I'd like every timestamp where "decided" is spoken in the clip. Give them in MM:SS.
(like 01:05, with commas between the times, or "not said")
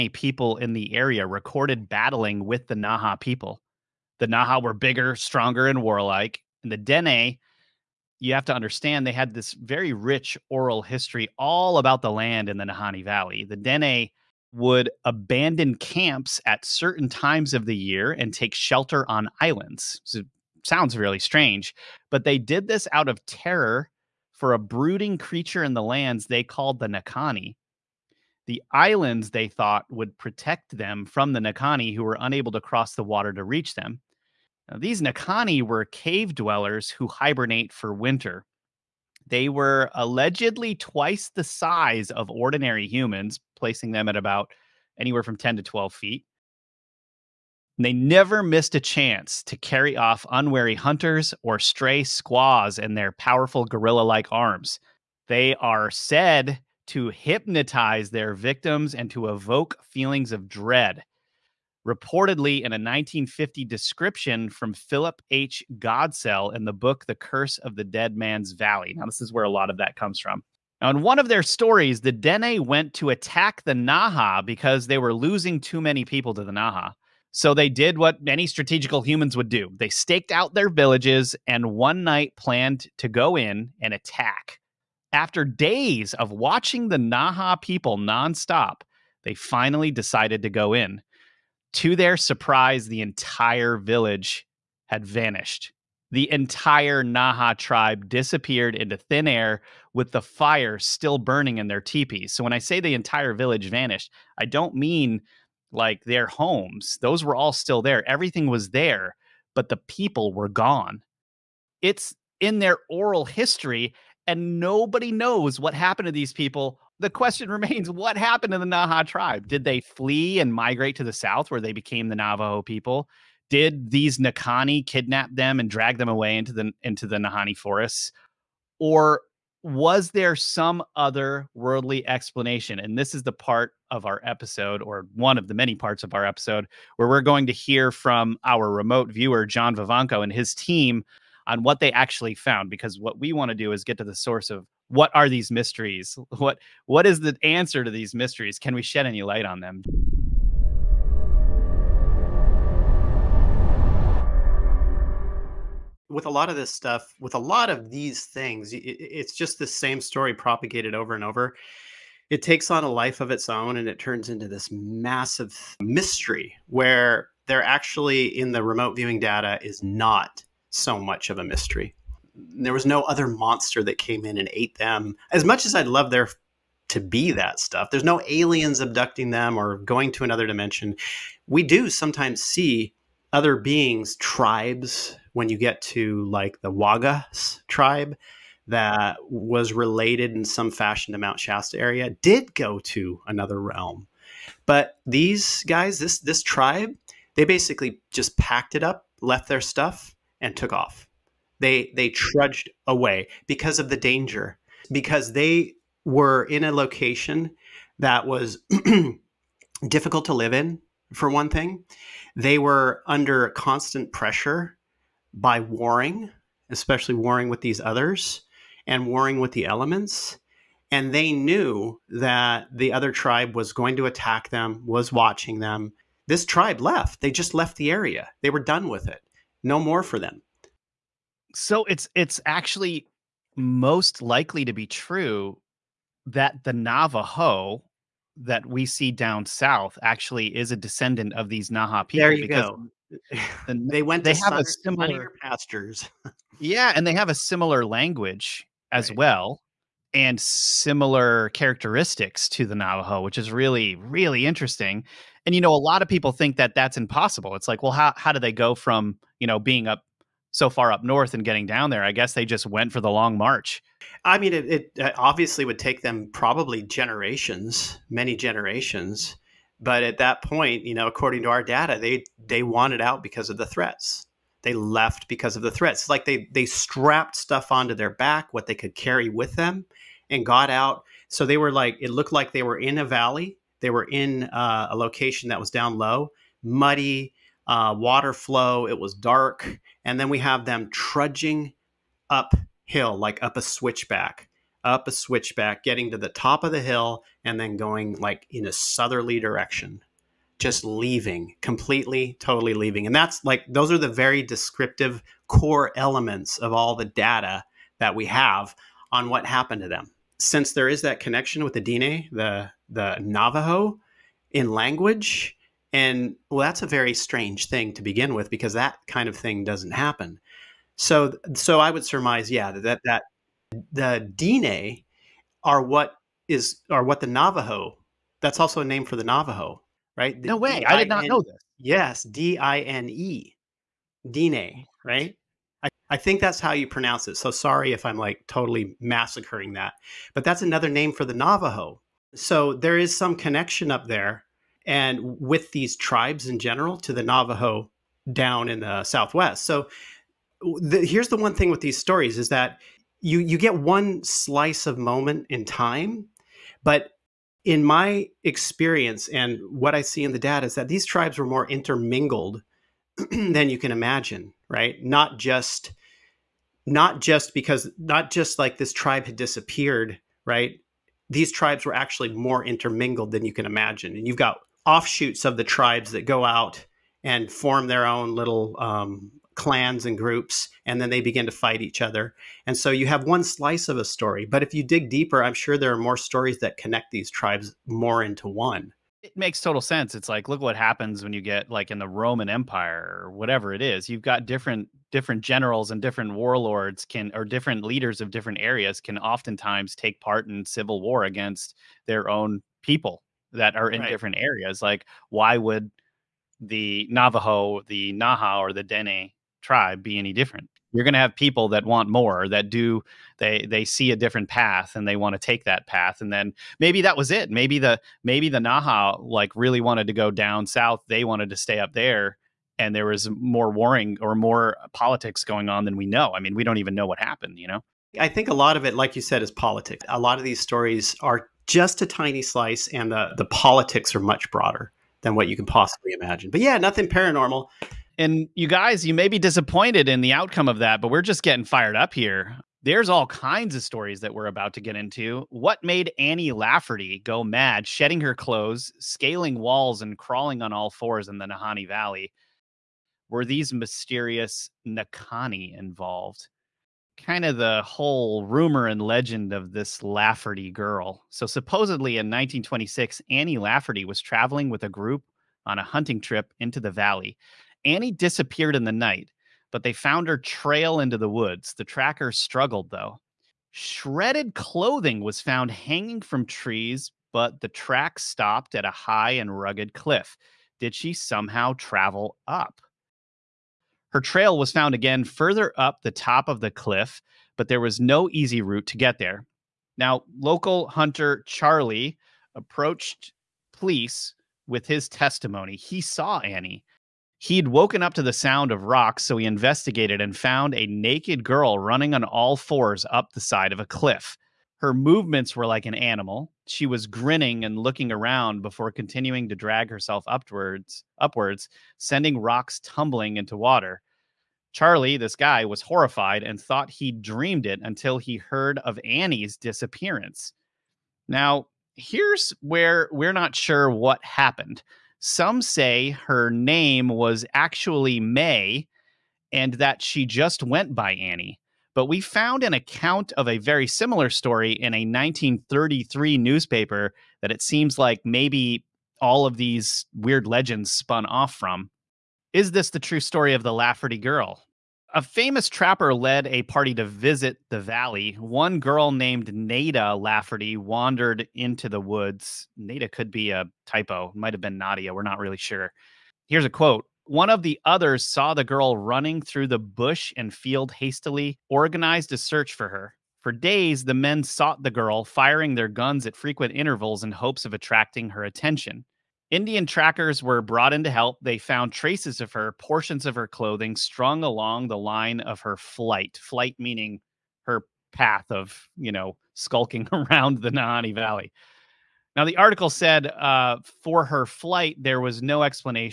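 01:29.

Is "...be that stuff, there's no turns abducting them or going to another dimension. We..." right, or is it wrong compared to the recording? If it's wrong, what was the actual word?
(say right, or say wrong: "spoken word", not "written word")
wrong: "aliens", not "turns".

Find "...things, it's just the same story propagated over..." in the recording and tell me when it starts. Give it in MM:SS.
02:38.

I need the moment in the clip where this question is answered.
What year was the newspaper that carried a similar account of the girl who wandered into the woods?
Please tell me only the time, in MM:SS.
08:55.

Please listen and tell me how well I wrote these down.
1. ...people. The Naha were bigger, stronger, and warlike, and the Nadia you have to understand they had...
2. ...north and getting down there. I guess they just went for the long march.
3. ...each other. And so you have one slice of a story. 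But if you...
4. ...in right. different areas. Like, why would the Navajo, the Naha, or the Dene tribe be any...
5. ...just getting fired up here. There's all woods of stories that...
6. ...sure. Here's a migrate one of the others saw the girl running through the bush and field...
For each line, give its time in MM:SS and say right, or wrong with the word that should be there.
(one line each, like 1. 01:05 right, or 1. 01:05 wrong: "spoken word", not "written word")
1. 00:03 wrong: "Dene", not "Nadia"
2. 04:21 right
3. 06:21 right
4. 06:43 right
5. 07:21 wrong: "kinds", not "woods"
6. 09:15 wrong: "quote", not "migrate".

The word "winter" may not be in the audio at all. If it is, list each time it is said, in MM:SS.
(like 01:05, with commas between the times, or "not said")
00:37.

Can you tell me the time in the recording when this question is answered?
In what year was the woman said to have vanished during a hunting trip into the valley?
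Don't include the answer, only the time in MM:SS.
07:42.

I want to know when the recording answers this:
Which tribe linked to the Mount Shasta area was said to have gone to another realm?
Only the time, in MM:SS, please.
03:06.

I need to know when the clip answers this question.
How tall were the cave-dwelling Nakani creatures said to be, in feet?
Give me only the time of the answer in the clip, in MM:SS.
00:45.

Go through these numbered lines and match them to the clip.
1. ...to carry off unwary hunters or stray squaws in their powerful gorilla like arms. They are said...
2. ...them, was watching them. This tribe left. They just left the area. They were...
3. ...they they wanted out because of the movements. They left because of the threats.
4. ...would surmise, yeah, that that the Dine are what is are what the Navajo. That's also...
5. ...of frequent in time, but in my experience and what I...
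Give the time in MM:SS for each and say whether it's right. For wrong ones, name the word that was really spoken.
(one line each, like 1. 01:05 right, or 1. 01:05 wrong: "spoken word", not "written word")
1. 00:49 right
2. 03:44 right
3. 04:31 wrong: "threats", not "movements"
4. 05:21 right
5. 05:54 wrong: "moment", not "frequent".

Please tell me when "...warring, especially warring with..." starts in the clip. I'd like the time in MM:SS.
03:35.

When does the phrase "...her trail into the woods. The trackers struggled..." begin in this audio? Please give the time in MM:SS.
07:50.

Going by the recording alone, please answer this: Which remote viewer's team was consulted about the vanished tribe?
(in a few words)
John Vivanco.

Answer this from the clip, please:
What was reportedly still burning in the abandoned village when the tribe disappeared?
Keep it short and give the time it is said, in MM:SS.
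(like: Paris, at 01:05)
The fire, at 01:40.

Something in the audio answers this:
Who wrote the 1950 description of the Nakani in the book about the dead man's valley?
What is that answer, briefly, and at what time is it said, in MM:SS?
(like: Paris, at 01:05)
Philip H. Godsell, at 01:04.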